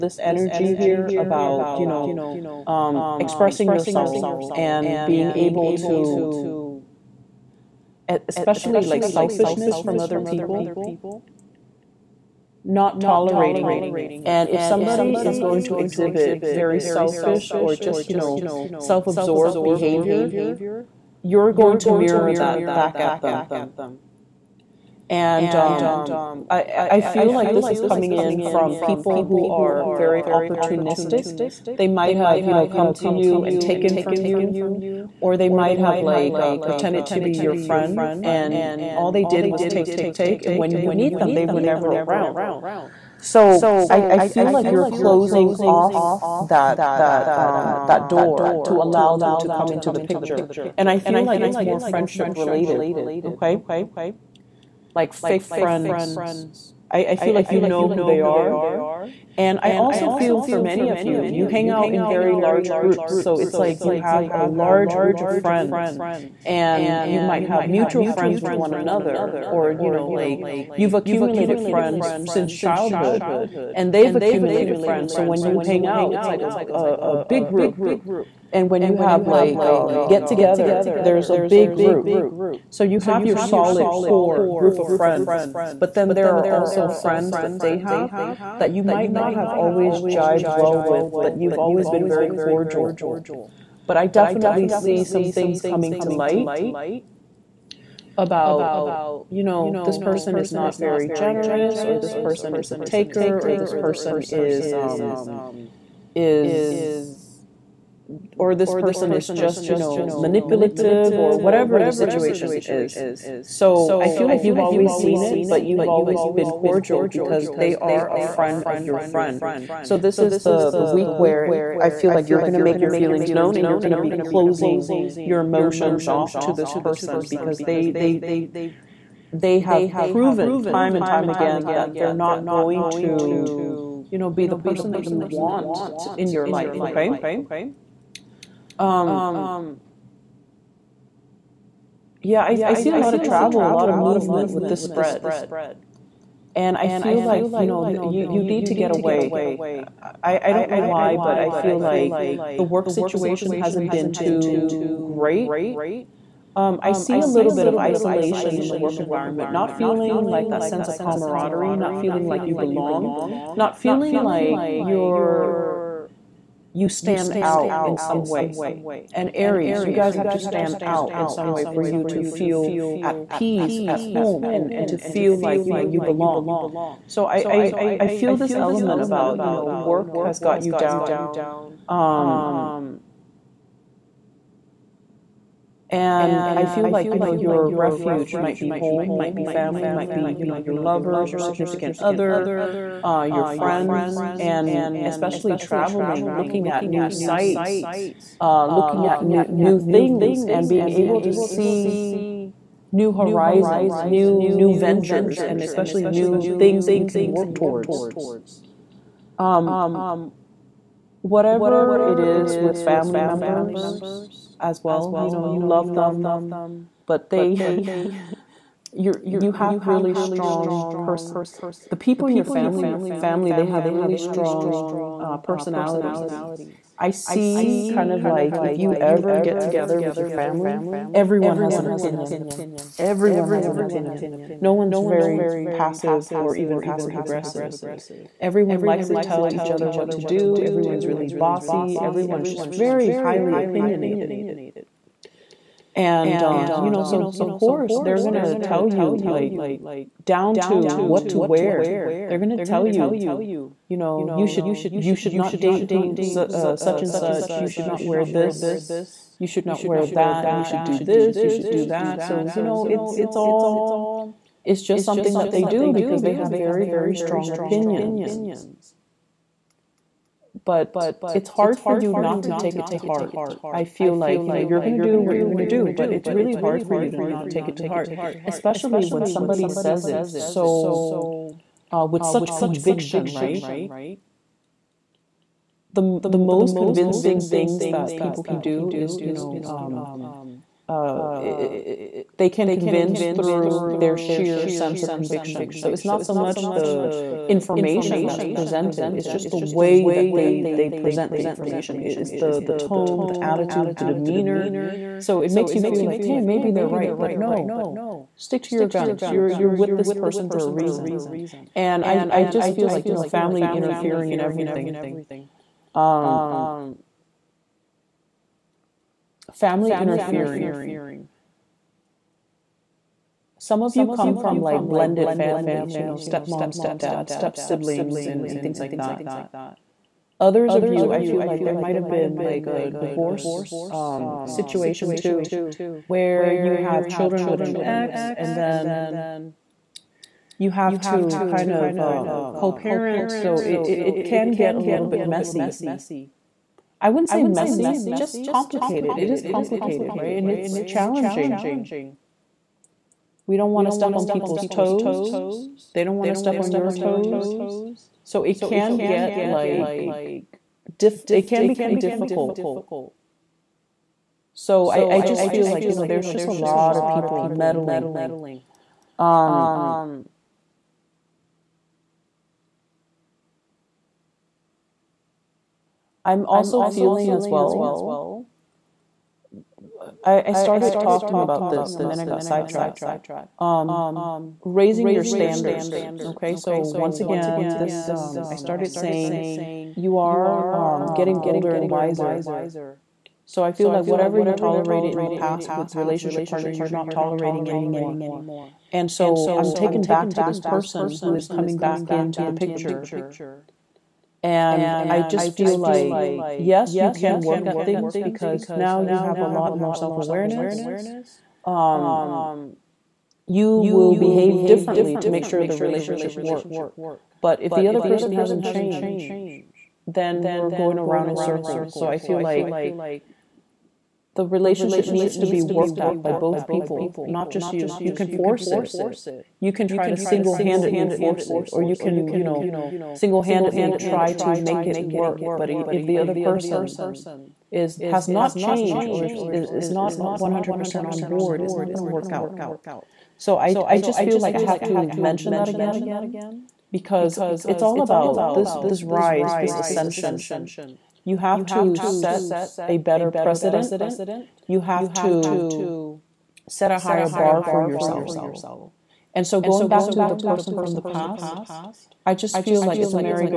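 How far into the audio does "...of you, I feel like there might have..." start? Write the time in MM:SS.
05:30.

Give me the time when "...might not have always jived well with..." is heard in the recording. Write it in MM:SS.
01:28.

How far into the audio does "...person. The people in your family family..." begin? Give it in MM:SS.
03:40.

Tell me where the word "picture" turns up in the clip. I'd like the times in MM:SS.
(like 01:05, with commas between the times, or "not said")
00:49, 06:42.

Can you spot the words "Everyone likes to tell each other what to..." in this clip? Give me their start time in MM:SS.
03:58.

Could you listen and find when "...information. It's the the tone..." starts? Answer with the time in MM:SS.
05:01.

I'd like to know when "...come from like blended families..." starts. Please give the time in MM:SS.
05:24.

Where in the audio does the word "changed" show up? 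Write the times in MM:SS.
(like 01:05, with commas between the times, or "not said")
06:58, 07:18.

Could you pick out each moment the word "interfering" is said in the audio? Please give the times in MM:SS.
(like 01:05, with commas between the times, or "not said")
05:13, 05:19.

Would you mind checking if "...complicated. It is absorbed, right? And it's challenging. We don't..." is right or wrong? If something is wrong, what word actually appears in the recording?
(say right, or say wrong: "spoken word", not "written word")
wrong: "complicated", not "absorbed".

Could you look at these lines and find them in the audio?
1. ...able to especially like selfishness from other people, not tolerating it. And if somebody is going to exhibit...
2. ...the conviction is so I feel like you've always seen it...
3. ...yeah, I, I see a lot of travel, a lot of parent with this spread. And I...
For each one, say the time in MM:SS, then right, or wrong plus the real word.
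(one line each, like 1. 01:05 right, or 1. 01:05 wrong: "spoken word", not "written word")
1. 00:05 right
2. 01:51 wrong: "situation", not "conviction"
3. 02:22 wrong: "movement", not "parent".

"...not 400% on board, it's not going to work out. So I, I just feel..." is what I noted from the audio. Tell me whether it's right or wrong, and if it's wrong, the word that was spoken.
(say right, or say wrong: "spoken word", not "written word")
wrong: "100", not "400".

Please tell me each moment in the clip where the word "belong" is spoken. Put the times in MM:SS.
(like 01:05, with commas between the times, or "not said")
02:42, 02:56.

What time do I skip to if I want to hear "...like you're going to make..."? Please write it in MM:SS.
02:02.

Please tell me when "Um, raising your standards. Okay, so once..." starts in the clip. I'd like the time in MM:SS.
06:23.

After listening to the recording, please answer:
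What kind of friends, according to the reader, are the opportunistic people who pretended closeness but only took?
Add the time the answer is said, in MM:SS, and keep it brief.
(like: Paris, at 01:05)
Fake friends, at 00:55.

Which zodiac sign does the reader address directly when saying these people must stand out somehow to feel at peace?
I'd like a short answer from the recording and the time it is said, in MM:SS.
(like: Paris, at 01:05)
Aries, at 02:49.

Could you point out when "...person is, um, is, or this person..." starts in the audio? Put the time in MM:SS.
01:43.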